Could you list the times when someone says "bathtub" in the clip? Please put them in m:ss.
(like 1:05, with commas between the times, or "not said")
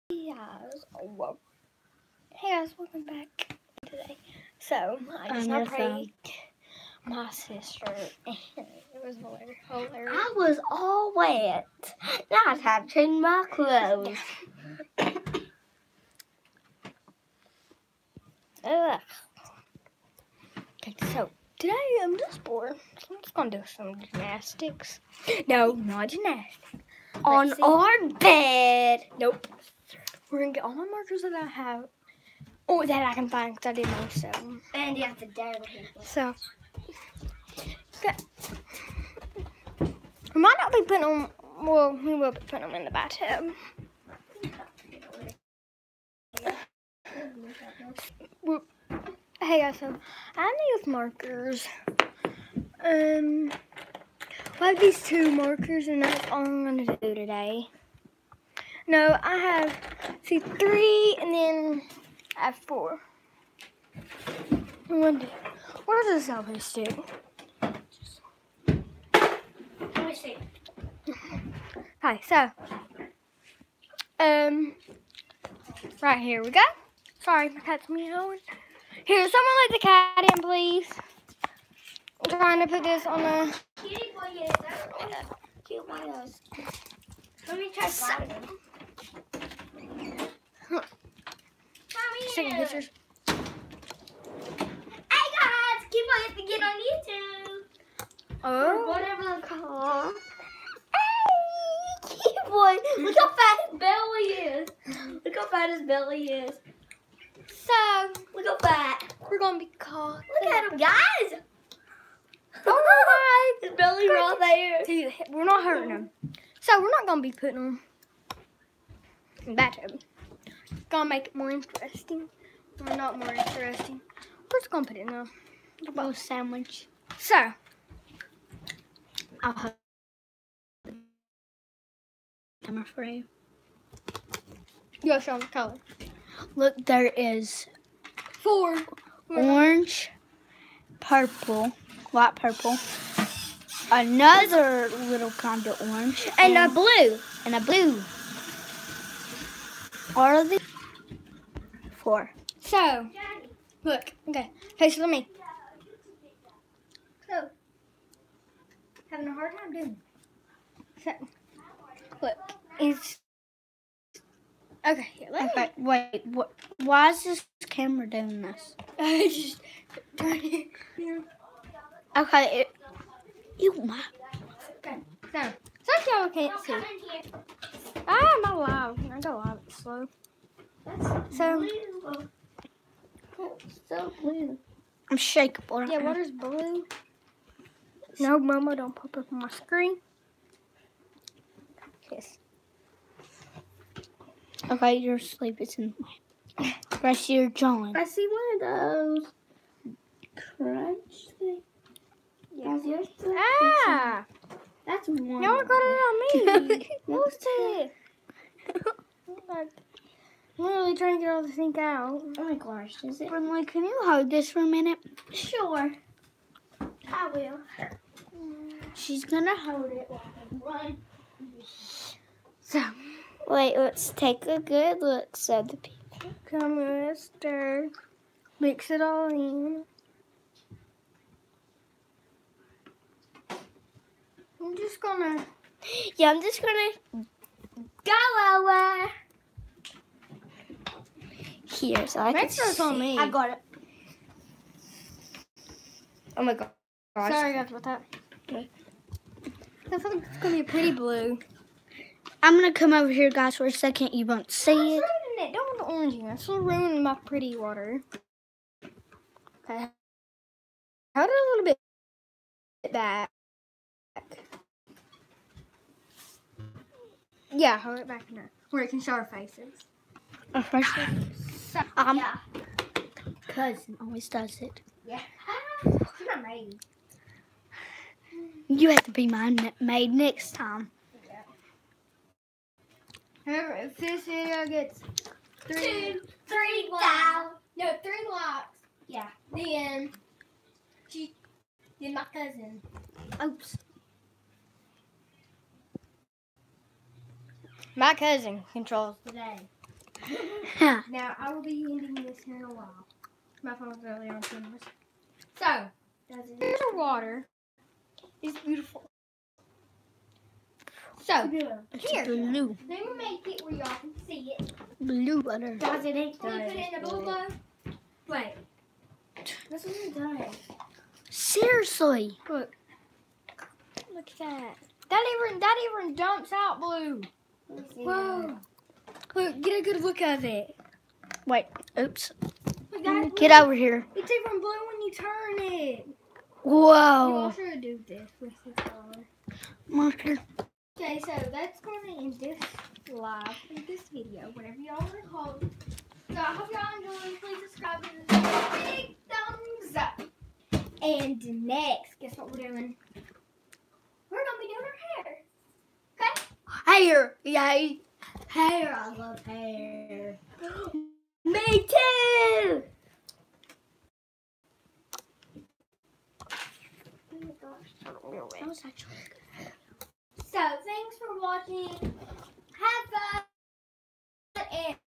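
0:42, 1:59.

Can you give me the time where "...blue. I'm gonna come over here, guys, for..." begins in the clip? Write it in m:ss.
4:10.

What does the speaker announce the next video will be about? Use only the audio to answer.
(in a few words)
doing our hair.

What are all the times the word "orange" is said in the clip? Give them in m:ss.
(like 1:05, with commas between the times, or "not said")
2:19, 2:25, 4:15.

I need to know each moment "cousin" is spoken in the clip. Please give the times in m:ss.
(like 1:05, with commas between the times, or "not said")
4:33, 4:52, 4:58.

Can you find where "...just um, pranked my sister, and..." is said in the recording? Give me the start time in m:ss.
0:05.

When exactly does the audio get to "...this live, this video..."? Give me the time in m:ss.
5:42.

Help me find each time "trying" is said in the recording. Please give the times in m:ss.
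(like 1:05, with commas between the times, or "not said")
1:22, 3:30.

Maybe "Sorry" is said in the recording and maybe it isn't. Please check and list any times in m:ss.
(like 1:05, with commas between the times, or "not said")
1:17, 4:07.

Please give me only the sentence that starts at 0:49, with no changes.
Hey guys, so I have these markers.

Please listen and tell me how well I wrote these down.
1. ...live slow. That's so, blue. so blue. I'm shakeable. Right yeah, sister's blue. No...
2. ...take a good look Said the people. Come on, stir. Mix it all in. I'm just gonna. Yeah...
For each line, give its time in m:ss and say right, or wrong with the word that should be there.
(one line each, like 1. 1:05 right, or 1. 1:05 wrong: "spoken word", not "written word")
1. 2:59 wrong: "water", not "sister"
2. 3:44 right.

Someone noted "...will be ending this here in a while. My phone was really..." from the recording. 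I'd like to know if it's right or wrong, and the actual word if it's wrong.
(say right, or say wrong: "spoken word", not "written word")
right.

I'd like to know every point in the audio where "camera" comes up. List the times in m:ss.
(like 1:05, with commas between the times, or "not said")
2:12, 2:47, 5:04.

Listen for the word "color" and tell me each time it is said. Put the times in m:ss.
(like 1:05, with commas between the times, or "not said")
2:15, 5:38.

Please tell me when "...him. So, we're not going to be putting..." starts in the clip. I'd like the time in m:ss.
1:55.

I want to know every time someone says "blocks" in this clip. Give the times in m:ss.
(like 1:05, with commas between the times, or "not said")
4:48.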